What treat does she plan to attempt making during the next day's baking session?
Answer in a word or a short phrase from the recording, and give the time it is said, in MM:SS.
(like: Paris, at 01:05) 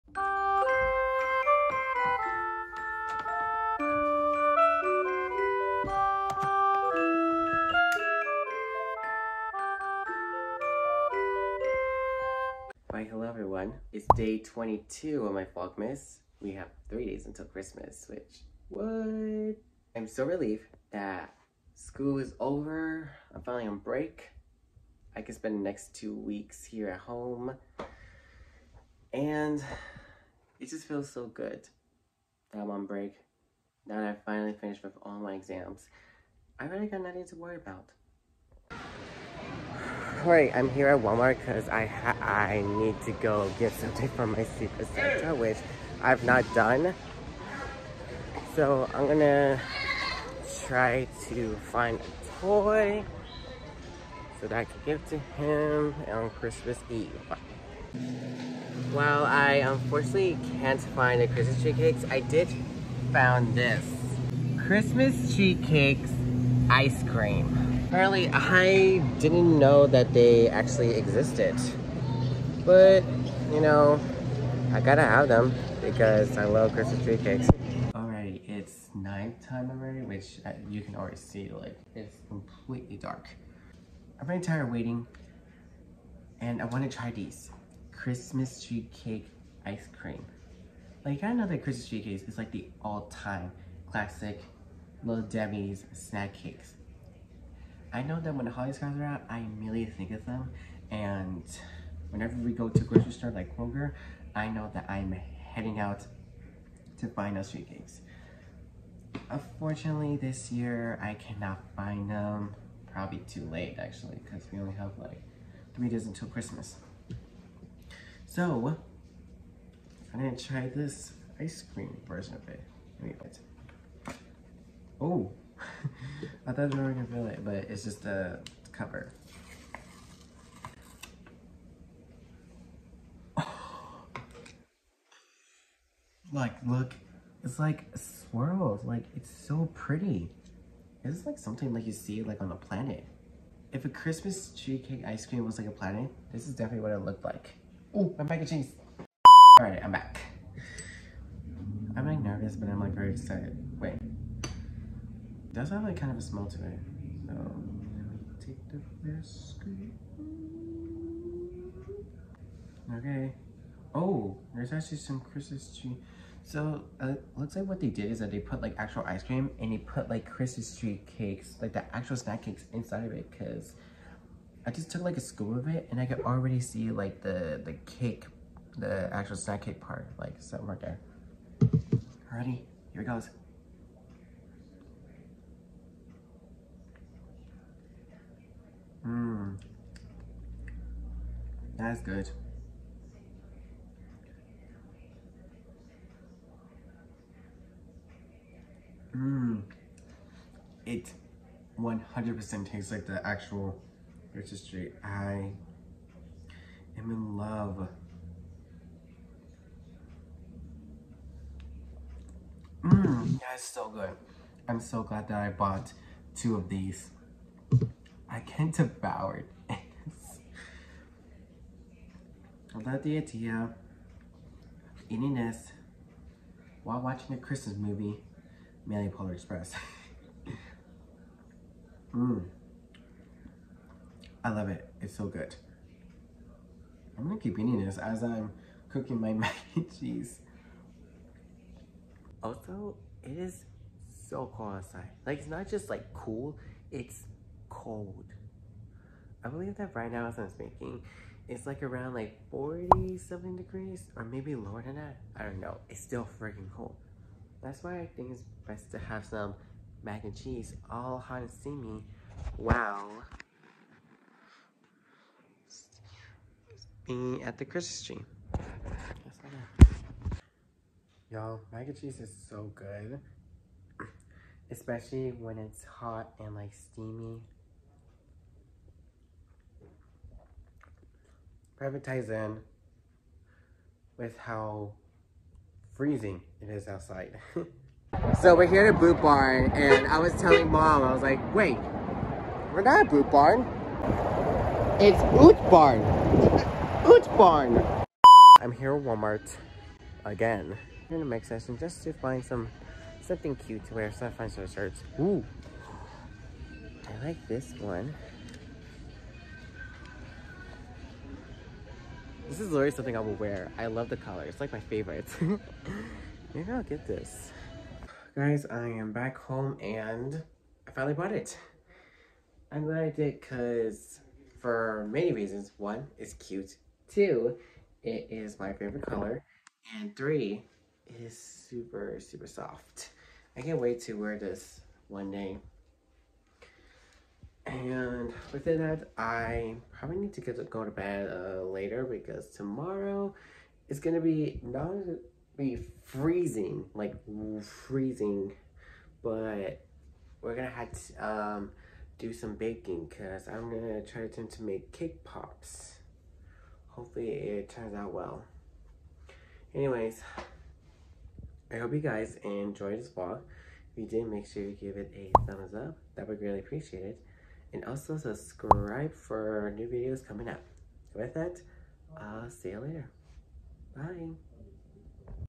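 Cake pops, at 05:54.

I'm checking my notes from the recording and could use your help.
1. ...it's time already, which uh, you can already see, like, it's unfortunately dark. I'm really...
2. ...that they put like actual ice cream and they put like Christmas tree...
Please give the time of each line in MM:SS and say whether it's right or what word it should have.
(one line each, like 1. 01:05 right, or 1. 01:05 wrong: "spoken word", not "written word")
1. 01:18 wrong: "completely", not "unfortunately"
2. 02:48 right.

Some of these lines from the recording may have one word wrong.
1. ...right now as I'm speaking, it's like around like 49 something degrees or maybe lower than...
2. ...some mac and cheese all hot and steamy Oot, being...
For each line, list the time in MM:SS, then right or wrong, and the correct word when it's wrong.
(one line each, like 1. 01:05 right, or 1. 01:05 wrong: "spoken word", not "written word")
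1. 04:09 wrong: "40", not "49"
2. 04:19 wrong: "Wow", not "Oot".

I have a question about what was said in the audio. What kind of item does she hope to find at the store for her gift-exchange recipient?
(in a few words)
A toy.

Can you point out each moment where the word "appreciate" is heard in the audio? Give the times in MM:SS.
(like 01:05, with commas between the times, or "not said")
06:06.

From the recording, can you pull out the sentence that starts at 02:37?
So let me take the first scoop.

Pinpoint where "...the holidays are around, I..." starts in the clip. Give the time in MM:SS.
01:38.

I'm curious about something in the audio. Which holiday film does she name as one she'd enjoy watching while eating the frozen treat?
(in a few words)
Polar Express.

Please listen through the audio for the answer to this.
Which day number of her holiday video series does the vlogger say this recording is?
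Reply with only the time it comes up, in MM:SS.
00:14.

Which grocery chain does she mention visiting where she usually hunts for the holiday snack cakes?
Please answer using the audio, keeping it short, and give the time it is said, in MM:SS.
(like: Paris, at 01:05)
Kroger, at 01:43.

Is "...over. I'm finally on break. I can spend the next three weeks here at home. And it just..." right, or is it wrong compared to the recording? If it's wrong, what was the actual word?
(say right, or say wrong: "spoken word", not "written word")
wrong: "two", not "three".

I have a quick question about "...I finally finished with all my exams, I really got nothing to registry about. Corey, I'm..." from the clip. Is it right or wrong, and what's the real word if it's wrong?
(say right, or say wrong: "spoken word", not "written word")
wrong: "worry", not "registry".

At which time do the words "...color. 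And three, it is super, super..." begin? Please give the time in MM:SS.
05:29.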